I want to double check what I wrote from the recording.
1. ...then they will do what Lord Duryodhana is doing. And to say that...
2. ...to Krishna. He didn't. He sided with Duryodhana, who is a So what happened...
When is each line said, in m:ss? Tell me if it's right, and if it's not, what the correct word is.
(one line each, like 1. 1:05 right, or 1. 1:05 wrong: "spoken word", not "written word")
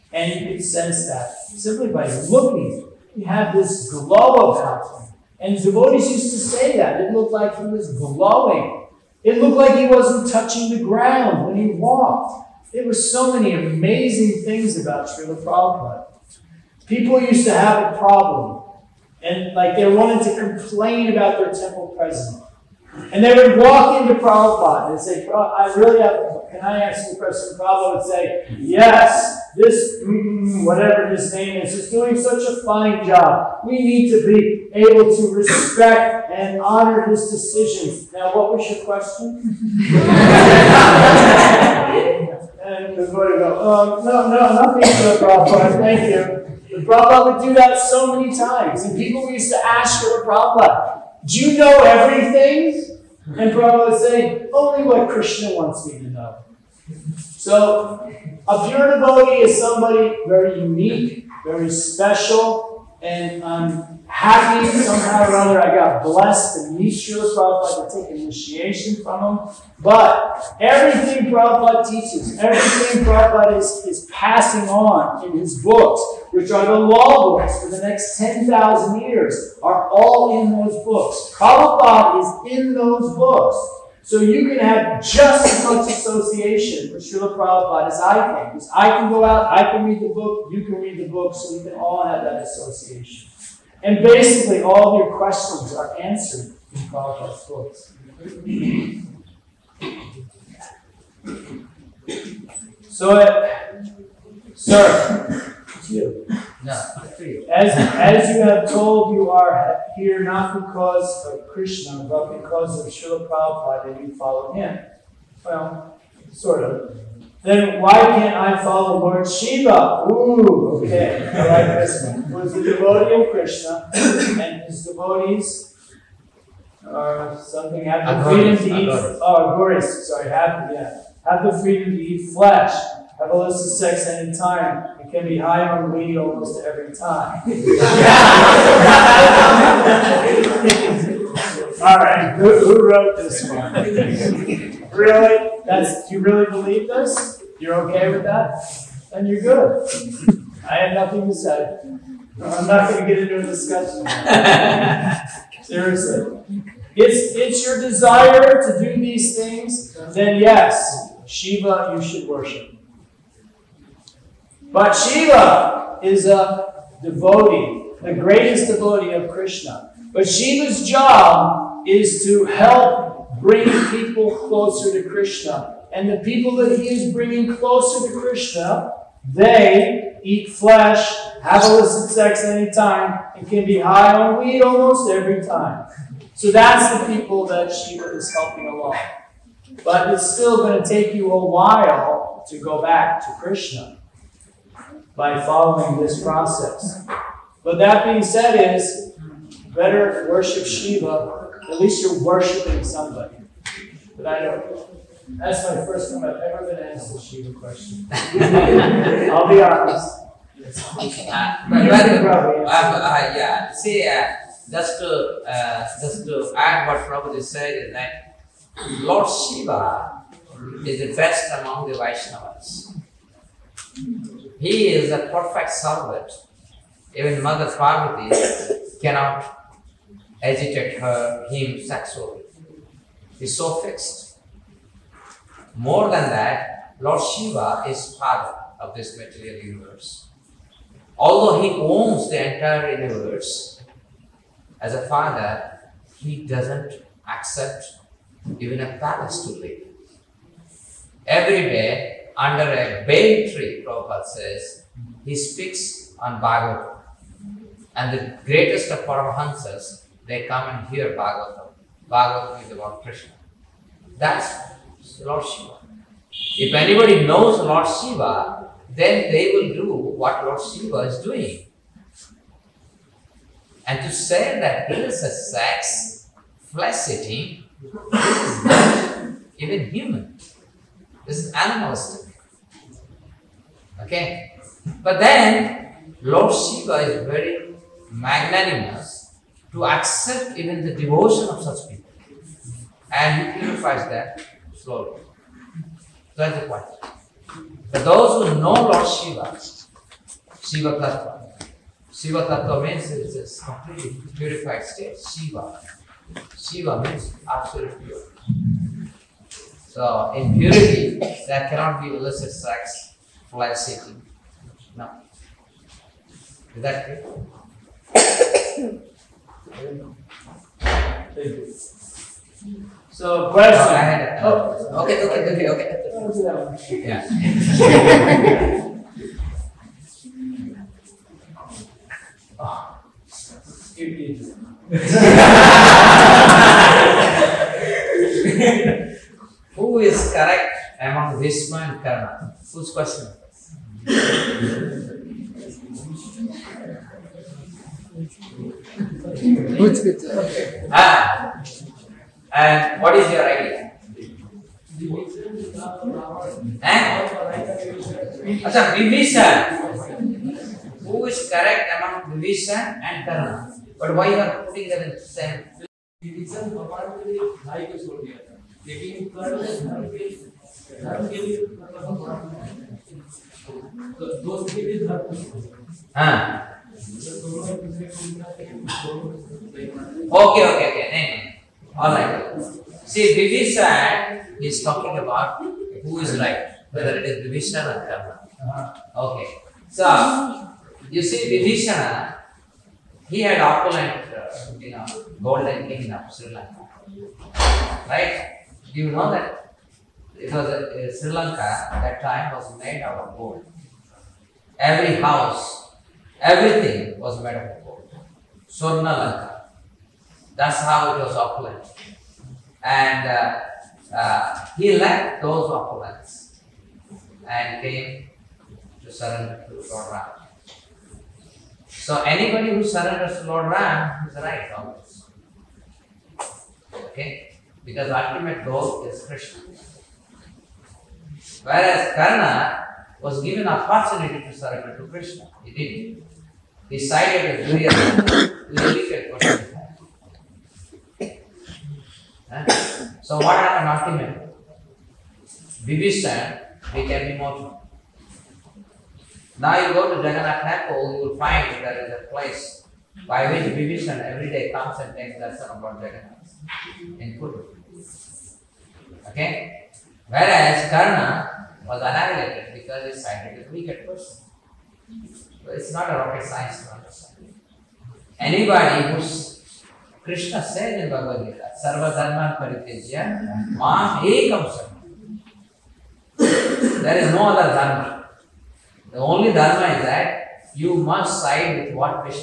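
1. 4:28 wrong: "Shiva", not "Duryodhana"
2. 7:14 right.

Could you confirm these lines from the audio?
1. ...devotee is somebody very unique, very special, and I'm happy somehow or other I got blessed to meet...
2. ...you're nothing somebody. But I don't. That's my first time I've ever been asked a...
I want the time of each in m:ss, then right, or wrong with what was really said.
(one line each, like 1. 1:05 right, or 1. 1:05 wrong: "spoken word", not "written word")
1. 0:58 right
2. 3:22 wrong: "worshiping", not "nothing".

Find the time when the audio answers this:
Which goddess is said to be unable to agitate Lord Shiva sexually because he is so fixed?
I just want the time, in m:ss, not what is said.
3:47.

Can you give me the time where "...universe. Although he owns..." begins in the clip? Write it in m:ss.
3:59.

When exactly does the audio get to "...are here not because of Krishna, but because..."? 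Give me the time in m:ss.
1:49.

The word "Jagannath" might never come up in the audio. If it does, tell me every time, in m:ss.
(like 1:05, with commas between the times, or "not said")
7:30, 7:35.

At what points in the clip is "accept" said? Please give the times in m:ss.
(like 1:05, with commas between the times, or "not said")
4:07, 4:49.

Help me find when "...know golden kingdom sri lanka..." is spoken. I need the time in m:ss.
6:34.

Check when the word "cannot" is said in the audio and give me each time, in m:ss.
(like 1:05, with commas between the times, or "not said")
3:49, 5:11.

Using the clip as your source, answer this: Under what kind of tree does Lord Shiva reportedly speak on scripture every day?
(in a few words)
A bay tree.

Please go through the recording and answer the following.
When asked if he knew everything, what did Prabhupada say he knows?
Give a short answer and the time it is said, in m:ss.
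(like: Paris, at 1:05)
Only what Krishna wants, at 0:54.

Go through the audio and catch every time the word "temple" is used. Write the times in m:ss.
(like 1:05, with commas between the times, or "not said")
0:21, 7:30.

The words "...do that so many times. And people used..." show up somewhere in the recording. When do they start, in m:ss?
0:47.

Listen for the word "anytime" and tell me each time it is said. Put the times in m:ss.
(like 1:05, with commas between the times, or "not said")
2:14, 3:02.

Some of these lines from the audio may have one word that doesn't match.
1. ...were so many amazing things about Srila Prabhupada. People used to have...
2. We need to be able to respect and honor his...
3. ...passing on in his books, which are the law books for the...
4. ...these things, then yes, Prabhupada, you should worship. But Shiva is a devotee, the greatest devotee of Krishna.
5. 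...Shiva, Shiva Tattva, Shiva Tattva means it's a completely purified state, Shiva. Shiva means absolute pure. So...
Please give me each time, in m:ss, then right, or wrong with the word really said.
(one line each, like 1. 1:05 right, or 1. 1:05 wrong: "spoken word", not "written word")
1. 0:12 right
2. 0:33 right
3. 1:14 right
4. 2:39 wrong: "Shiva", not "Prabhupada"
5. 4:59 right.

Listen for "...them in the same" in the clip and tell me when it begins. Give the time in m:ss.
6:04.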